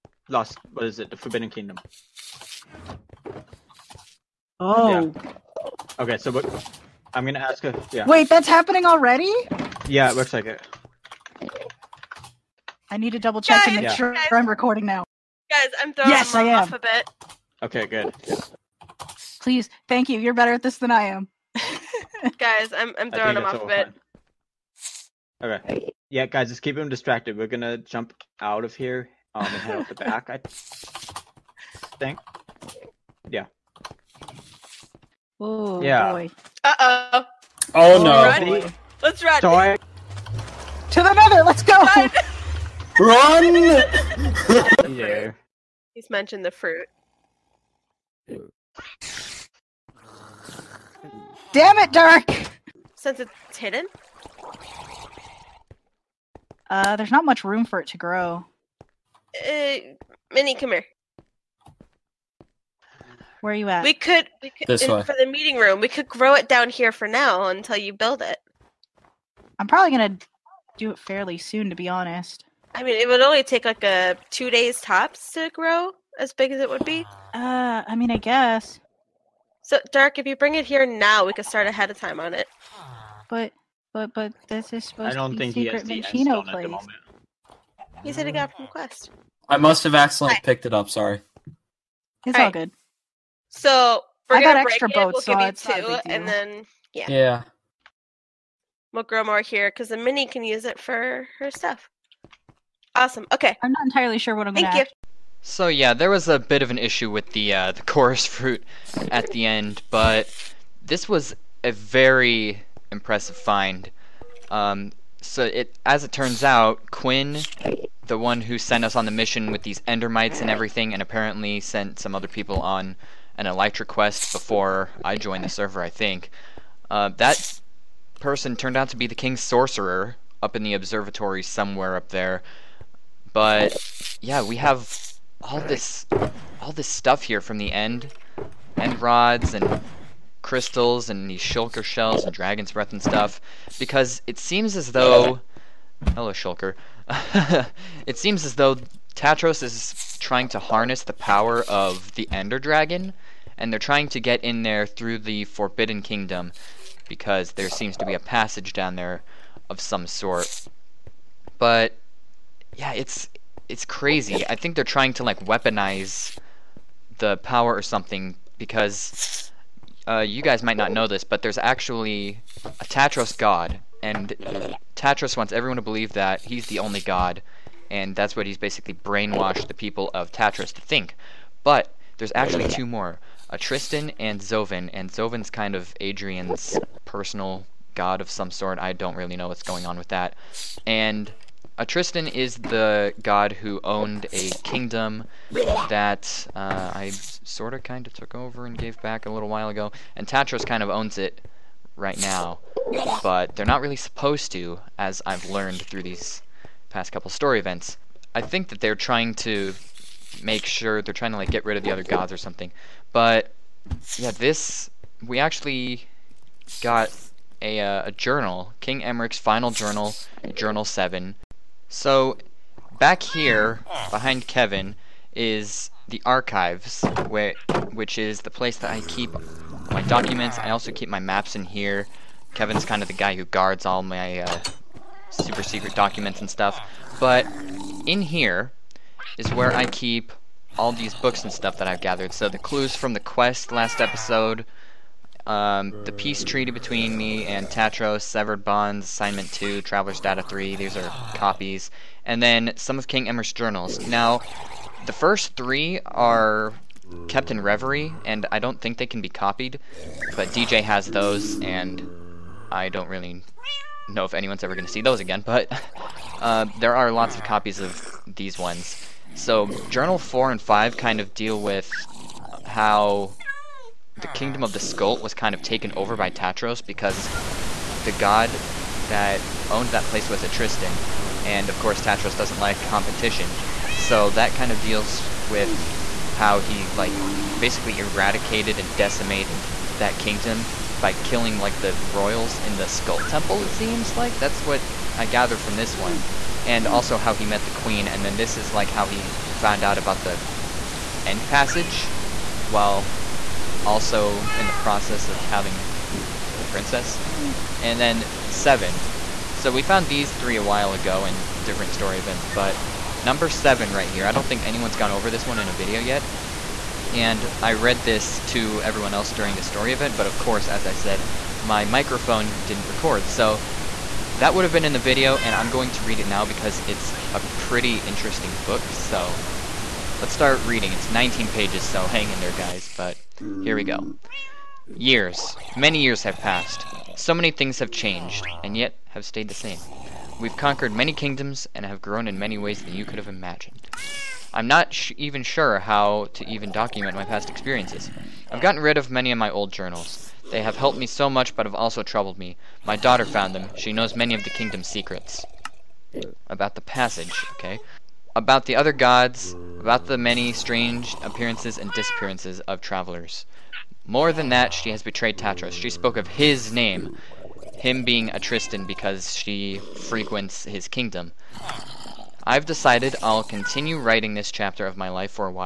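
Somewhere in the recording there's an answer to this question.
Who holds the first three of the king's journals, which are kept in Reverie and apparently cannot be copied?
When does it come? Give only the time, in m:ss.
4:20.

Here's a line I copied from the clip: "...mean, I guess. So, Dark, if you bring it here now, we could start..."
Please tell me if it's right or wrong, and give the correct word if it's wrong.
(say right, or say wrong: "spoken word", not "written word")
right.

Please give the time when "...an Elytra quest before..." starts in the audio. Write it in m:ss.
2:03.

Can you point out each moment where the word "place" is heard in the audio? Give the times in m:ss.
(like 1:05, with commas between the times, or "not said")
1:26, 3:48, 4:40.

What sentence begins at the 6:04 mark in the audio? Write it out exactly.
More than that, she has betrayed Tatros.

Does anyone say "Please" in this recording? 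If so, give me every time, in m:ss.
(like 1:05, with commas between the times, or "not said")
0:19.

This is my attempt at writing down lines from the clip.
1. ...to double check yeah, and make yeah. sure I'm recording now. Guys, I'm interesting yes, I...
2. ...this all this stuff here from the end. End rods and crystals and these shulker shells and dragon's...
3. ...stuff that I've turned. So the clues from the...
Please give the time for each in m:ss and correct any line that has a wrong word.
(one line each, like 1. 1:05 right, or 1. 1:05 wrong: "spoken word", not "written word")
1. 0:13 wrong: "throwing", not "interesting"
2. 2:15 right
3. 4:01 wrong: "gathered", not "turned".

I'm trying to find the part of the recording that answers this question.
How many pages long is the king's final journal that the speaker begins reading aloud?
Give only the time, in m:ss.
5:31.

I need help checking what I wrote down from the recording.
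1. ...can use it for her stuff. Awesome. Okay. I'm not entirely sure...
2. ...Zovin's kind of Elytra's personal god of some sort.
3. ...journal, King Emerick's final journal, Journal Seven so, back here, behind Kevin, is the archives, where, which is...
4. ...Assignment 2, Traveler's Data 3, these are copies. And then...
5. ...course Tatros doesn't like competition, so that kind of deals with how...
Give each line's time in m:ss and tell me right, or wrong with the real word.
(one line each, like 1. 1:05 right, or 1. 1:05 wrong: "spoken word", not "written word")
1. 1:40 right
2. 3:05 wrong: "Adrian", not "Elytra"
3. 3:38 right
4. 4:09 right
5. 4:41 right.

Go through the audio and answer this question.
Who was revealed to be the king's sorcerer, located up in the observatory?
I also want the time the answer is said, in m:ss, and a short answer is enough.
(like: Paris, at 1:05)
Quinn, at 1:56.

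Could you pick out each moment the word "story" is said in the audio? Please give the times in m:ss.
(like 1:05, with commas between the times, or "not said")
3:27, 5:11, 5:19.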